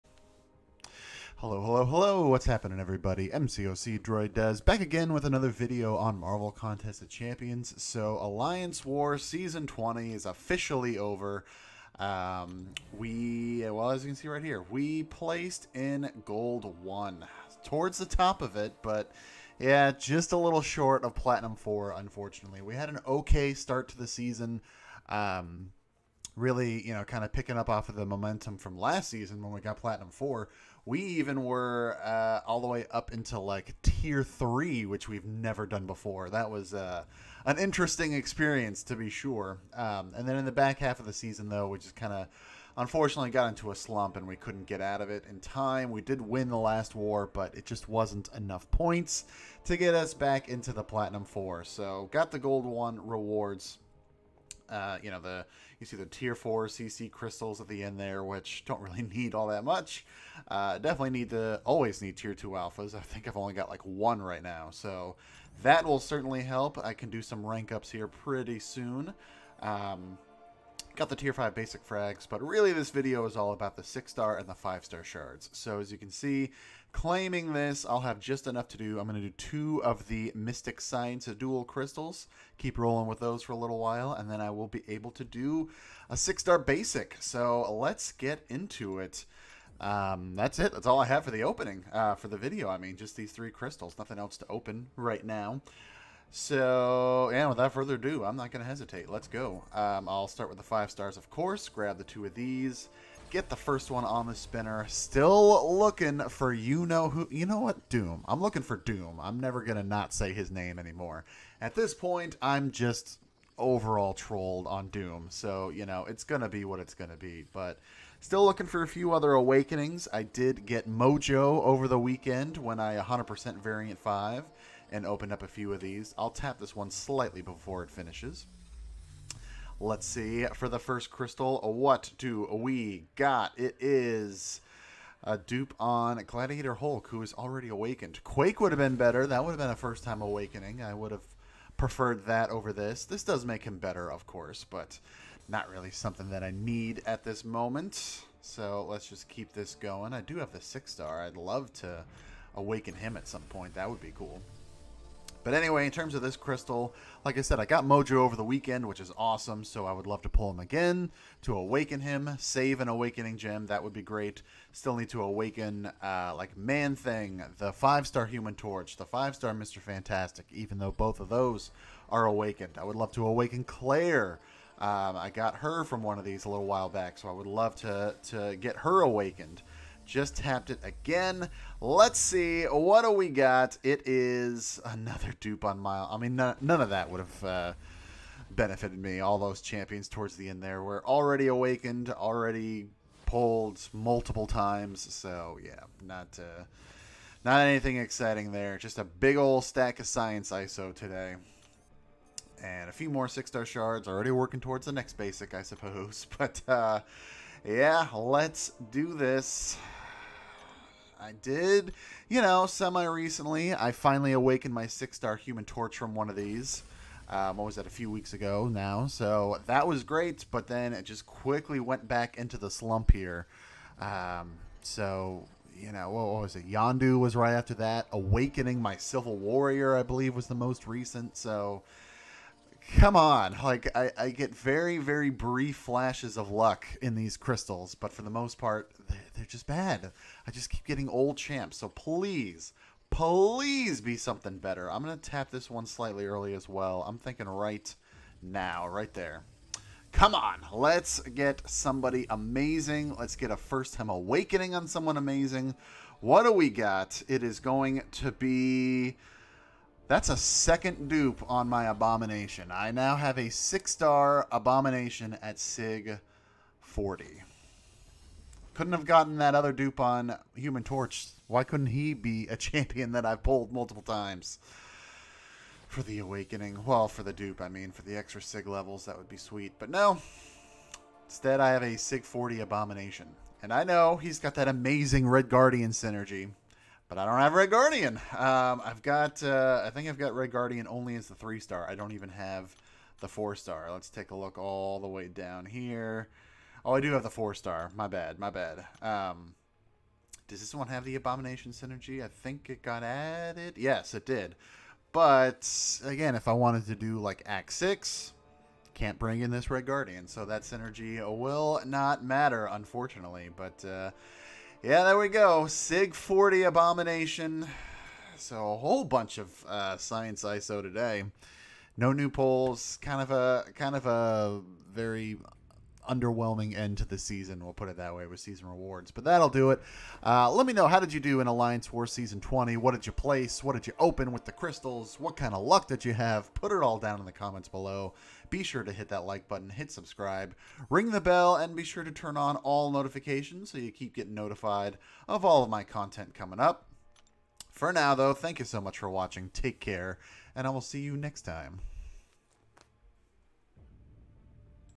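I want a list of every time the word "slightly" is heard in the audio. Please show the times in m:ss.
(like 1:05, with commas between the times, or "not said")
2:06, 4:05.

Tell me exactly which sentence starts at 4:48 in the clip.
Um, I've got, uh, I think I've got Red Guardian only as the three star.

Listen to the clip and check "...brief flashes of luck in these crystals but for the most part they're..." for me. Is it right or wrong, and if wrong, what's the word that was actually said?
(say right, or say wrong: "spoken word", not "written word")
right.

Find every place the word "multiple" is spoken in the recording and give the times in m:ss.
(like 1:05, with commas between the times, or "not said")
3:13, 4:33.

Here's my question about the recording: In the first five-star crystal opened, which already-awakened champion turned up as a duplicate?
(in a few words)
Gladiator Hulk.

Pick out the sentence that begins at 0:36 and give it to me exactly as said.
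That was uh, an interesting experience to be sure.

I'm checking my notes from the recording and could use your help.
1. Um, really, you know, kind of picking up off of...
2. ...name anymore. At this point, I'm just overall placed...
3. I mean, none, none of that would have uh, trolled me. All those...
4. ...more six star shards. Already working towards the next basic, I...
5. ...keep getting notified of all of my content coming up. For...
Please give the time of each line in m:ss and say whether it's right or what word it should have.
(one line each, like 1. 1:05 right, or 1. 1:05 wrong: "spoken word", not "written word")
1. 0:25 right
2. 1:50 wrong: "trolled", not "placed"
3. 3:06 wrong: "benefited", not "trolled"
4. 3:23 right
5. 5:43 right.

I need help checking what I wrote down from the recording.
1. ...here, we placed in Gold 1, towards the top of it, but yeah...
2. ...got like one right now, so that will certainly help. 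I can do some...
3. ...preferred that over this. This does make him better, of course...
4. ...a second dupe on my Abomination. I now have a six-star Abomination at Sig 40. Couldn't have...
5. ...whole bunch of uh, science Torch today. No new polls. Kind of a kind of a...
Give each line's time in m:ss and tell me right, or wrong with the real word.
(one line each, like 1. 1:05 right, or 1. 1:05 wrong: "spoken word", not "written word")
1. 0:14 right
2. 1:03 right
3. 2:21 right
4. 4:20 right
5. 5:18 wrong: "ISO", not "Torch".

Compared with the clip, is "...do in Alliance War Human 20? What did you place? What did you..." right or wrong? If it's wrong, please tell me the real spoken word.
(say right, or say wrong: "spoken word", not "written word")
wrong: "Season", not "Human".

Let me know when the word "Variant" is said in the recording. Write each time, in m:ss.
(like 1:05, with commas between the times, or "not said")
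2:03.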